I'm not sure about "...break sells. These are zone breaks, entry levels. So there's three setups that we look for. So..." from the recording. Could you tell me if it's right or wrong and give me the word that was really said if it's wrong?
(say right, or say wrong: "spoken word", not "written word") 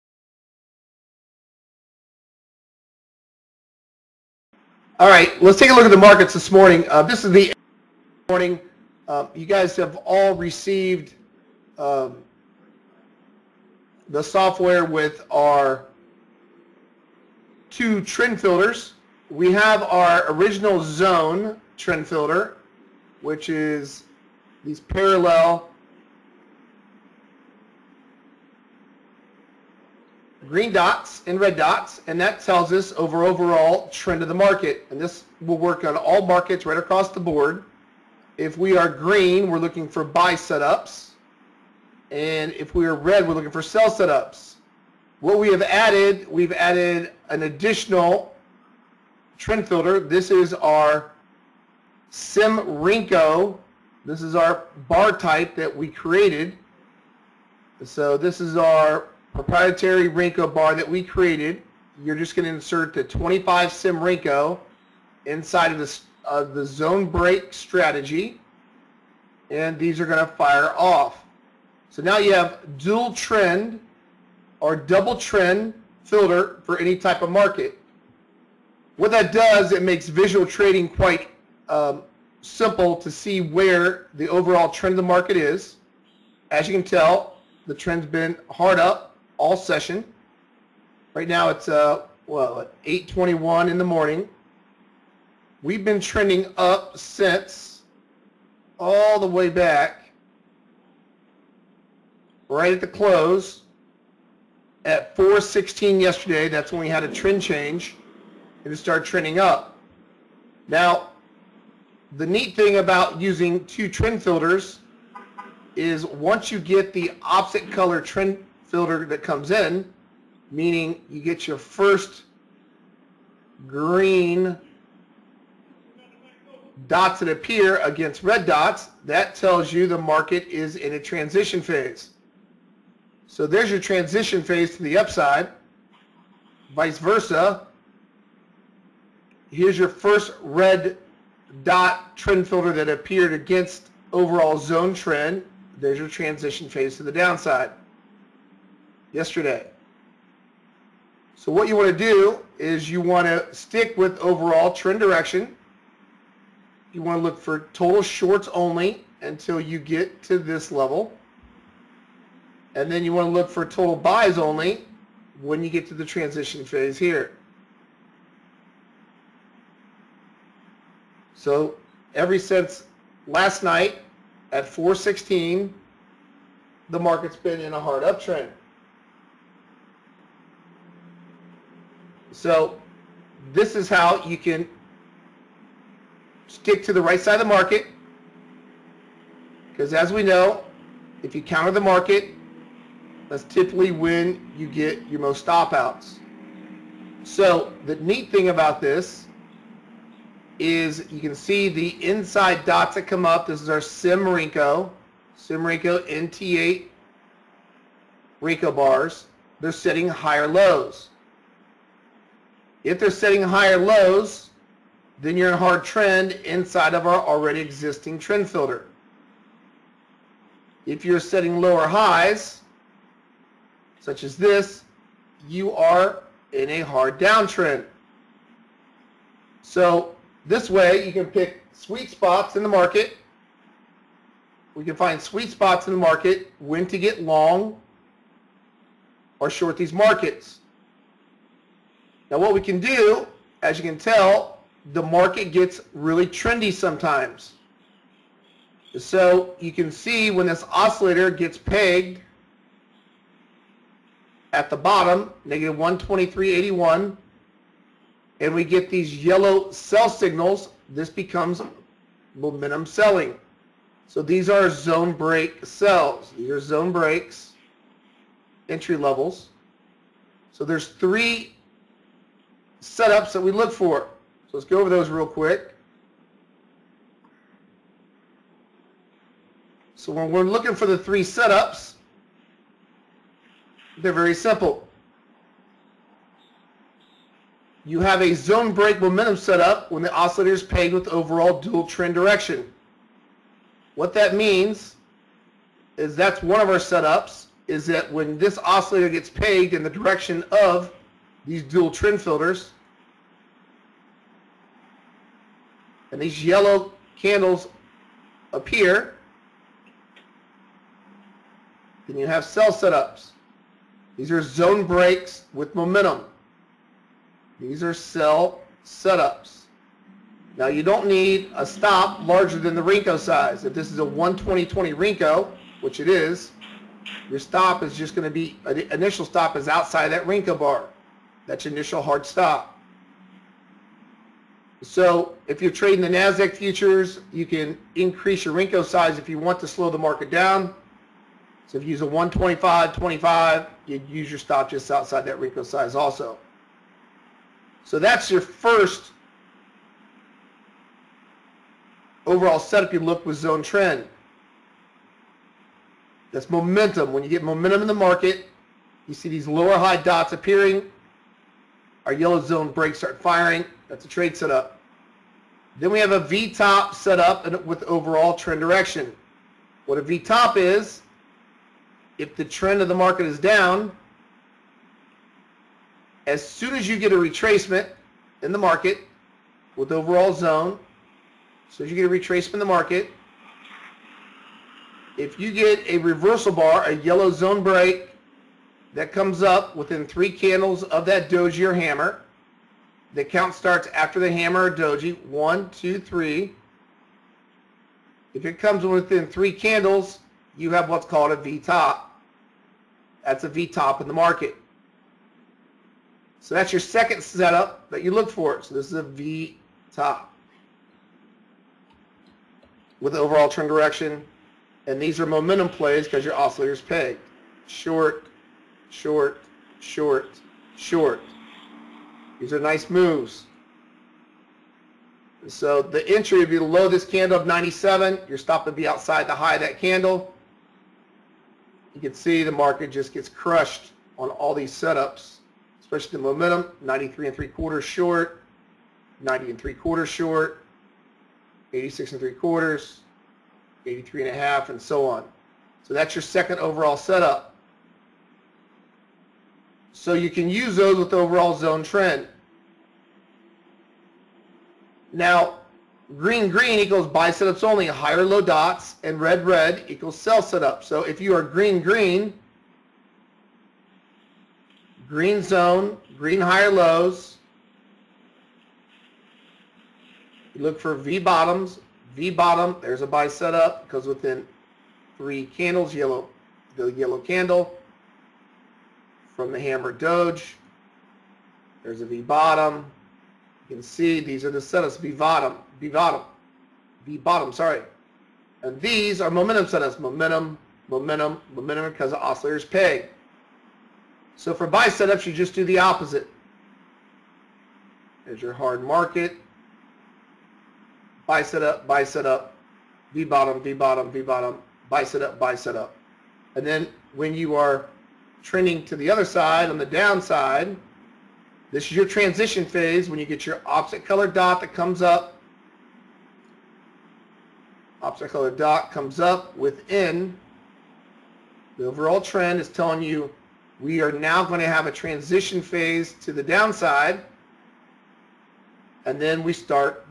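right.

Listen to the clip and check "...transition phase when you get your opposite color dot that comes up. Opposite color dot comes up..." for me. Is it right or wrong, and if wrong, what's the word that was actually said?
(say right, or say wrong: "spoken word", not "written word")
right.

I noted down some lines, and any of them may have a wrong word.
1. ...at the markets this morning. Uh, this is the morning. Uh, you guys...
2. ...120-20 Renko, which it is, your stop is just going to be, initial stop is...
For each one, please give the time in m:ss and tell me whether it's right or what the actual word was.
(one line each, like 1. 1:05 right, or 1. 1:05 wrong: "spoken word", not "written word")
1. 0:05 right
2. 5:24 right.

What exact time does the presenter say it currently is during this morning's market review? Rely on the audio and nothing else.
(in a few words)
8:21.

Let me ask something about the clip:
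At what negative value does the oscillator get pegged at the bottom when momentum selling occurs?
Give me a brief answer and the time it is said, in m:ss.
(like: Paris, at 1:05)
-123.81, at 4:15.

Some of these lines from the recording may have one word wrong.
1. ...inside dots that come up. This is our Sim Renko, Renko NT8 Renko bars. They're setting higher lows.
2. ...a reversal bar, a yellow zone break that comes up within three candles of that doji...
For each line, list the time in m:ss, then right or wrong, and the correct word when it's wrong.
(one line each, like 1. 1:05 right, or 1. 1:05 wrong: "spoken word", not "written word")
1. 3:22 wrong: "Sim", not "Renko"
2. 6:25 right.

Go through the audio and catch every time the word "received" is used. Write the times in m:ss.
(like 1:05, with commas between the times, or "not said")
0:10.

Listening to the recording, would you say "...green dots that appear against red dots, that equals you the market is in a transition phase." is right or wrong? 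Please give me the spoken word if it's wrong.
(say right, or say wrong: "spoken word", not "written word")
wrong: "tells", not "equals".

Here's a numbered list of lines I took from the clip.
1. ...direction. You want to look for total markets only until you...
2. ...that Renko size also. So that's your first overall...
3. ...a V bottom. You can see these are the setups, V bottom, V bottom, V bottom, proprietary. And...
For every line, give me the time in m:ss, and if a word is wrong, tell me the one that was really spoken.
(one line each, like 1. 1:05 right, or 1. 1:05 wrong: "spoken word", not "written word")
1. 2:34 wrong: "shorts", not "markets"
2. 5:45 right
3. 8:02 wrong: "sorry", not "proprietary".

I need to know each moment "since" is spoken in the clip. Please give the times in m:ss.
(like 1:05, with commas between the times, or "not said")
1:36, 2:52.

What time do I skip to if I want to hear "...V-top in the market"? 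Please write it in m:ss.
6:43.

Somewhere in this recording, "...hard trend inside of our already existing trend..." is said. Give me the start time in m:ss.
3:35.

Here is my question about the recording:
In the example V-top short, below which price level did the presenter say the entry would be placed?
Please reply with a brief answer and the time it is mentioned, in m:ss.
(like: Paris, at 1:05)
97, at 7:07.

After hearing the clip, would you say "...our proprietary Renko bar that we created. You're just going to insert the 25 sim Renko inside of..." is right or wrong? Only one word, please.
right.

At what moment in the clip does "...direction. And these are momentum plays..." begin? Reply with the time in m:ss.
6:53.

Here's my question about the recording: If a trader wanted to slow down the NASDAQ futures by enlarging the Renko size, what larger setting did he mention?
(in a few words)
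125-25.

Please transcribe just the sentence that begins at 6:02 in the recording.
Our yellow zone breaks start firing.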